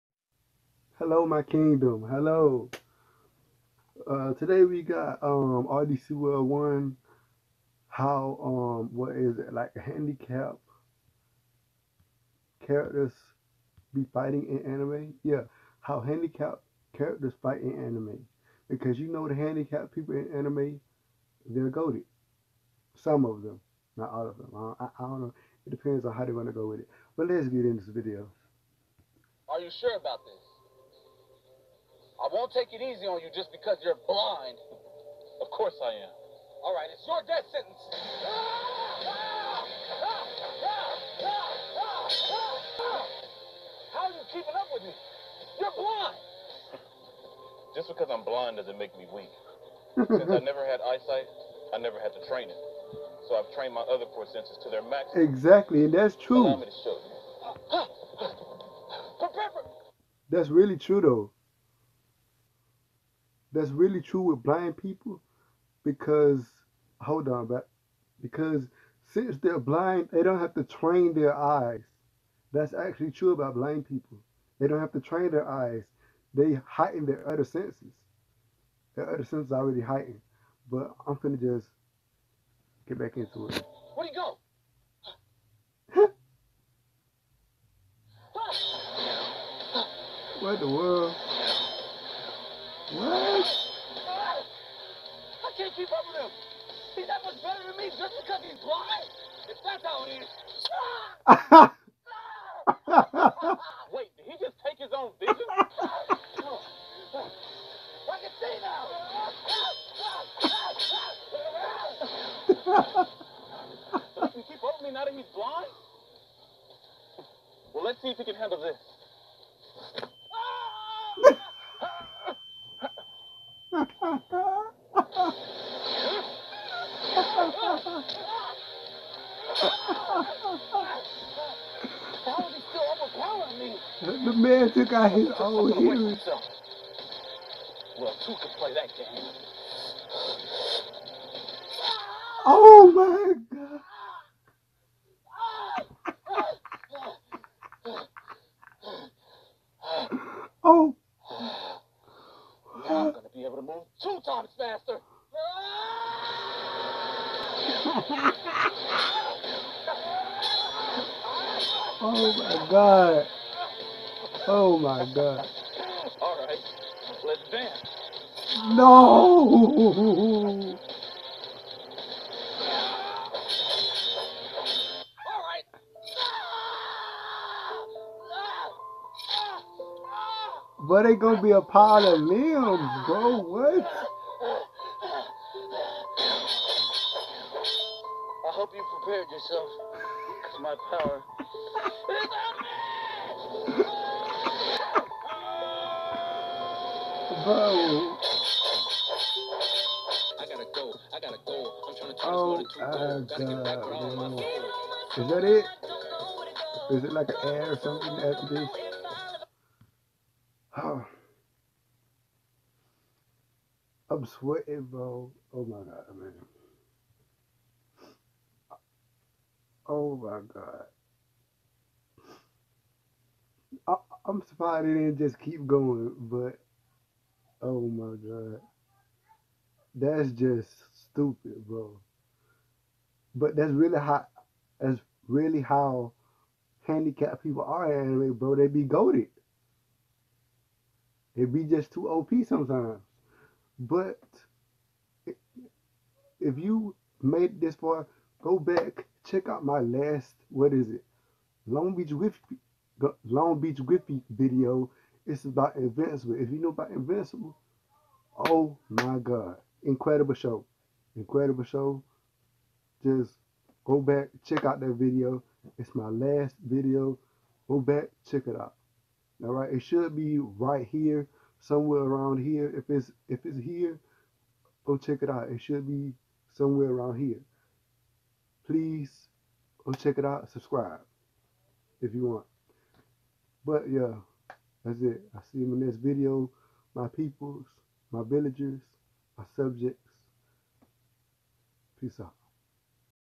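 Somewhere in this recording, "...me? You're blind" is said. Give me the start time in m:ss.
0:44.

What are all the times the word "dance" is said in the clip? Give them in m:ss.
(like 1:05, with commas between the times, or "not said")
2:47.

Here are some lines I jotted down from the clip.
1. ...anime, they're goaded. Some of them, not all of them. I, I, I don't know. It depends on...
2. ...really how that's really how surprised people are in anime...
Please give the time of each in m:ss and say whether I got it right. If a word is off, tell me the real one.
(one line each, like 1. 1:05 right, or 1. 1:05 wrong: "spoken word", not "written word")
1. 0:20 right
2. 3:53 wrong: "handicapped", not "surprised".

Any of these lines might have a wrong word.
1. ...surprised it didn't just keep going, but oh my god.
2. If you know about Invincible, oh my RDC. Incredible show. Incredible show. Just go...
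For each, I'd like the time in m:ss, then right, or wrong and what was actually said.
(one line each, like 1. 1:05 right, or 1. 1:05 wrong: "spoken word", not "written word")
1. 3:44 right
2. 4:16 wrong: "God", not "RDC".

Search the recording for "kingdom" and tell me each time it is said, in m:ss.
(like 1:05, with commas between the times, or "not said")
0:01.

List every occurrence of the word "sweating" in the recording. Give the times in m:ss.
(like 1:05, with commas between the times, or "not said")
3:34.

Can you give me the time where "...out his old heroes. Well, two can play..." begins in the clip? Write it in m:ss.
2:14.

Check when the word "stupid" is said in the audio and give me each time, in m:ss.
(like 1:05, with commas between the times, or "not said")
3:50.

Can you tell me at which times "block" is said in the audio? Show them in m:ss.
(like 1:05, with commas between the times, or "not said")
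not said.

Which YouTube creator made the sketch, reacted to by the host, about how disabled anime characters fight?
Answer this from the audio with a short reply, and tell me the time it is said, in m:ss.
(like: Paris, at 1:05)
RDC World 1, at 0:05.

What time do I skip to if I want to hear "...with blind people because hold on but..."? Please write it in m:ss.
1:04.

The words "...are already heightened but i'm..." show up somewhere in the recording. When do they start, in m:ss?
1:19.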